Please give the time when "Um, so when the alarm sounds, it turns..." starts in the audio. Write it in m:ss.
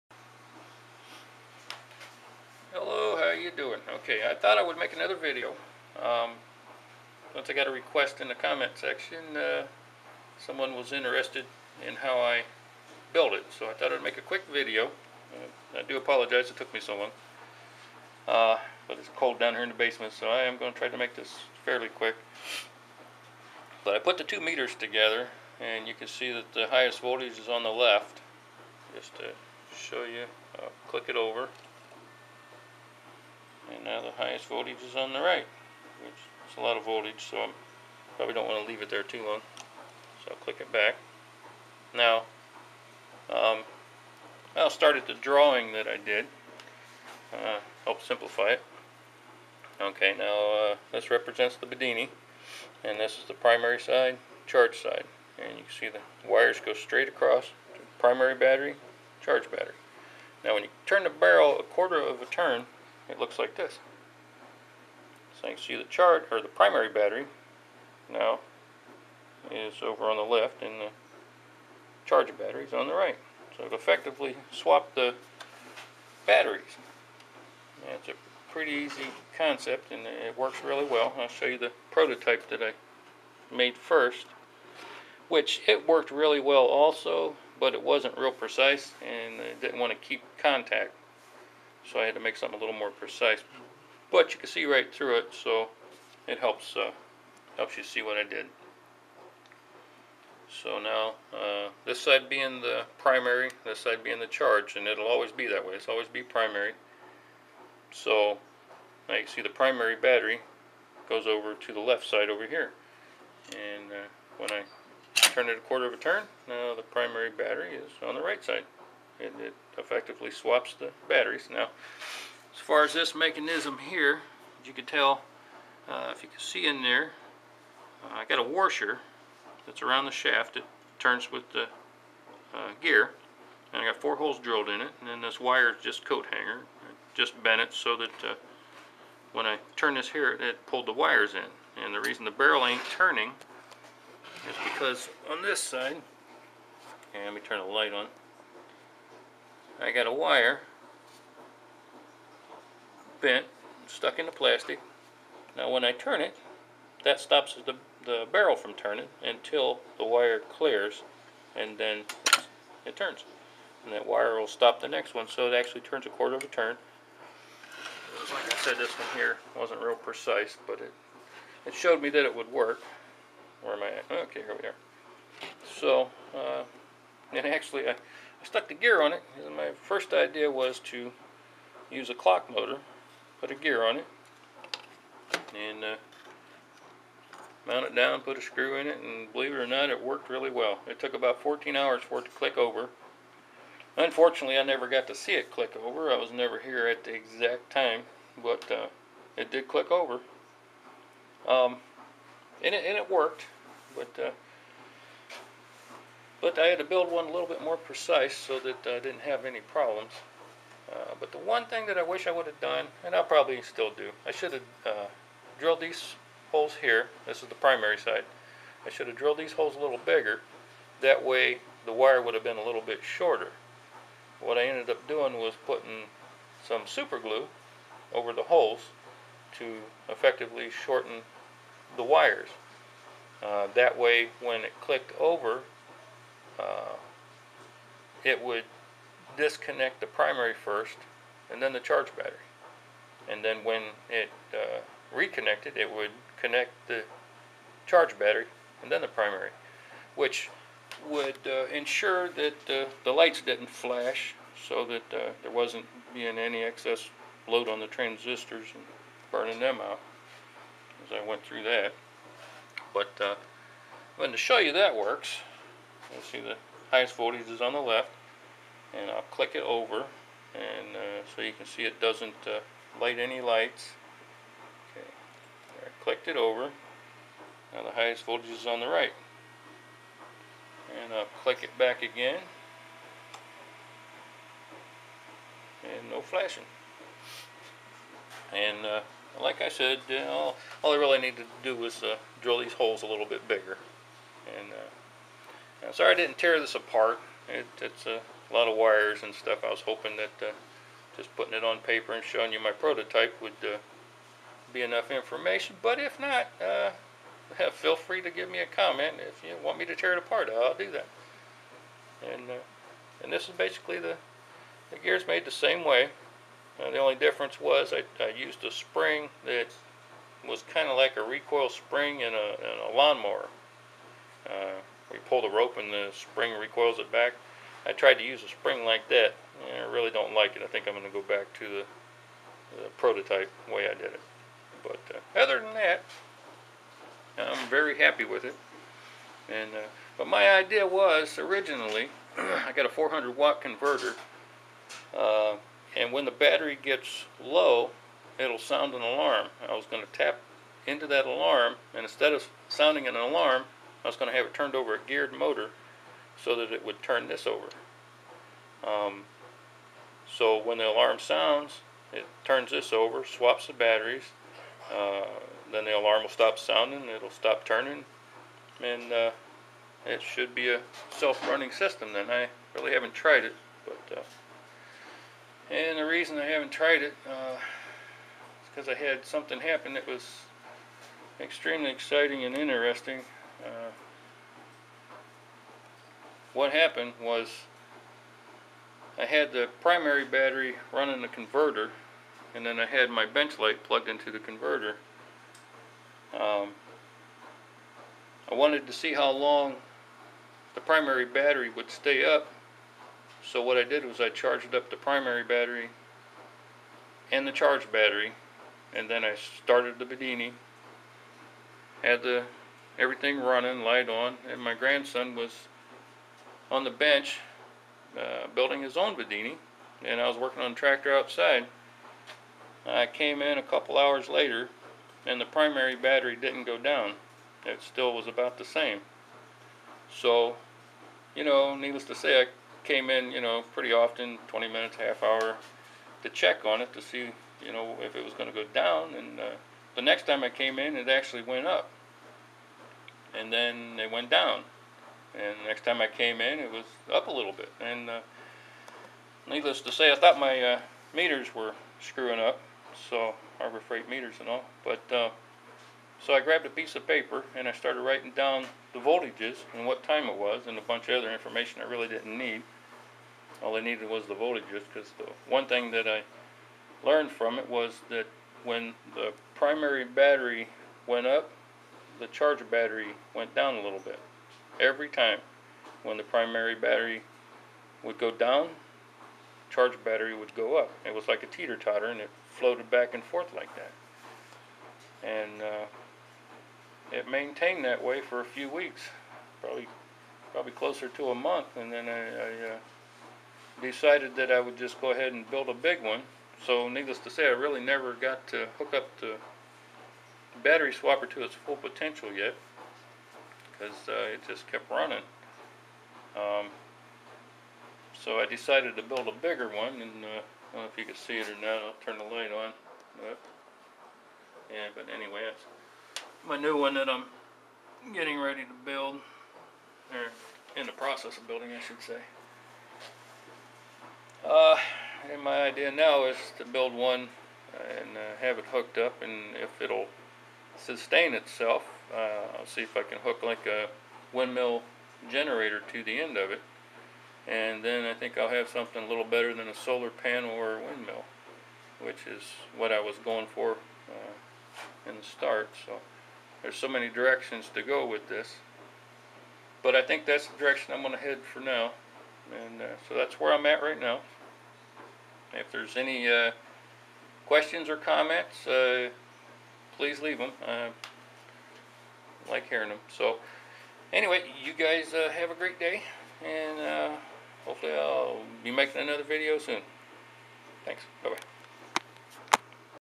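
5:58.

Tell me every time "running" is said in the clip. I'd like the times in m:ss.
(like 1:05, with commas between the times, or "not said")
6:11, 6:30, 6:53, 8:24.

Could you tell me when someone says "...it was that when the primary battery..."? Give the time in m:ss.
7:47.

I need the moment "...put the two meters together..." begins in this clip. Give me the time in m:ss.
0:23.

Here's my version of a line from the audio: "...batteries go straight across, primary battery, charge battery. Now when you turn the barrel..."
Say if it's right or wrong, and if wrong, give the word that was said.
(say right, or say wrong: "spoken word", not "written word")
wrong: "wires", not "batteries".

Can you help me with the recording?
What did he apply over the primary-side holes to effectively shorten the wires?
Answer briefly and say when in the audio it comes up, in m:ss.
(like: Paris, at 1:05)
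Super glue, at 3:46.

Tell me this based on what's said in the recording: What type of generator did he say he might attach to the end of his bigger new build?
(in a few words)
Windmill generator.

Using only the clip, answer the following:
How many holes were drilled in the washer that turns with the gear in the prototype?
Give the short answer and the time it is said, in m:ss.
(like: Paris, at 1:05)
4, at 2:13.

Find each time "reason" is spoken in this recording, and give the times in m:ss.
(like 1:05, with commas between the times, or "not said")
2:22, 6:16.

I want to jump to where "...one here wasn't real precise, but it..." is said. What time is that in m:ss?
2:48.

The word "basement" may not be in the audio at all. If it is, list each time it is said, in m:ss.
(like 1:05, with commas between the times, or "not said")
0:19.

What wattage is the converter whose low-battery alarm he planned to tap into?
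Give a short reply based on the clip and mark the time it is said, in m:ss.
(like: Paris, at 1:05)
400 watt, at 5:42.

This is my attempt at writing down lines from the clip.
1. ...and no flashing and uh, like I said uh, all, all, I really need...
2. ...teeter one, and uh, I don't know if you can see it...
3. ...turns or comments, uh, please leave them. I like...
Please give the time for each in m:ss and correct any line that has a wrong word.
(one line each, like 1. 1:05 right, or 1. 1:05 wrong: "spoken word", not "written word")
1. 4:45 right
2. 8:29 wrong: "bigger", not "teeter"
3. 9:17 wrong: "questions", not "turns".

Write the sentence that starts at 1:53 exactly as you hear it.
And uh, when I turn it a quarter of a turn, now the primary battery is on the right side.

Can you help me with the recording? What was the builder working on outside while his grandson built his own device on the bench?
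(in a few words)
A tractor.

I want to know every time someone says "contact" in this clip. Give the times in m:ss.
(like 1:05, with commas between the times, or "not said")
1:30.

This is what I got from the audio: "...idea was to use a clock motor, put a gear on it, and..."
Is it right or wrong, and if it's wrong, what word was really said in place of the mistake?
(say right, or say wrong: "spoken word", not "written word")
right.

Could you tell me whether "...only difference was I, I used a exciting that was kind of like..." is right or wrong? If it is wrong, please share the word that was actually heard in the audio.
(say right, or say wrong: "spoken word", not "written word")
wrong: "spring", not "exciting".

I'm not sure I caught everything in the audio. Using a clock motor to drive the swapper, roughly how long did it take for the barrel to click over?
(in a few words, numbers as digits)
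14 hours.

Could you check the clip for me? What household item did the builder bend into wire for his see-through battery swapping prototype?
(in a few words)
Coat hanger.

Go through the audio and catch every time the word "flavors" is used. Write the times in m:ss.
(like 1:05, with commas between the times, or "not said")
not said.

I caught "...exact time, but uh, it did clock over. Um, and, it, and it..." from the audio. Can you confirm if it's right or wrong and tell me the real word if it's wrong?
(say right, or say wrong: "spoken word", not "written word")
wrong: "click", not "clock".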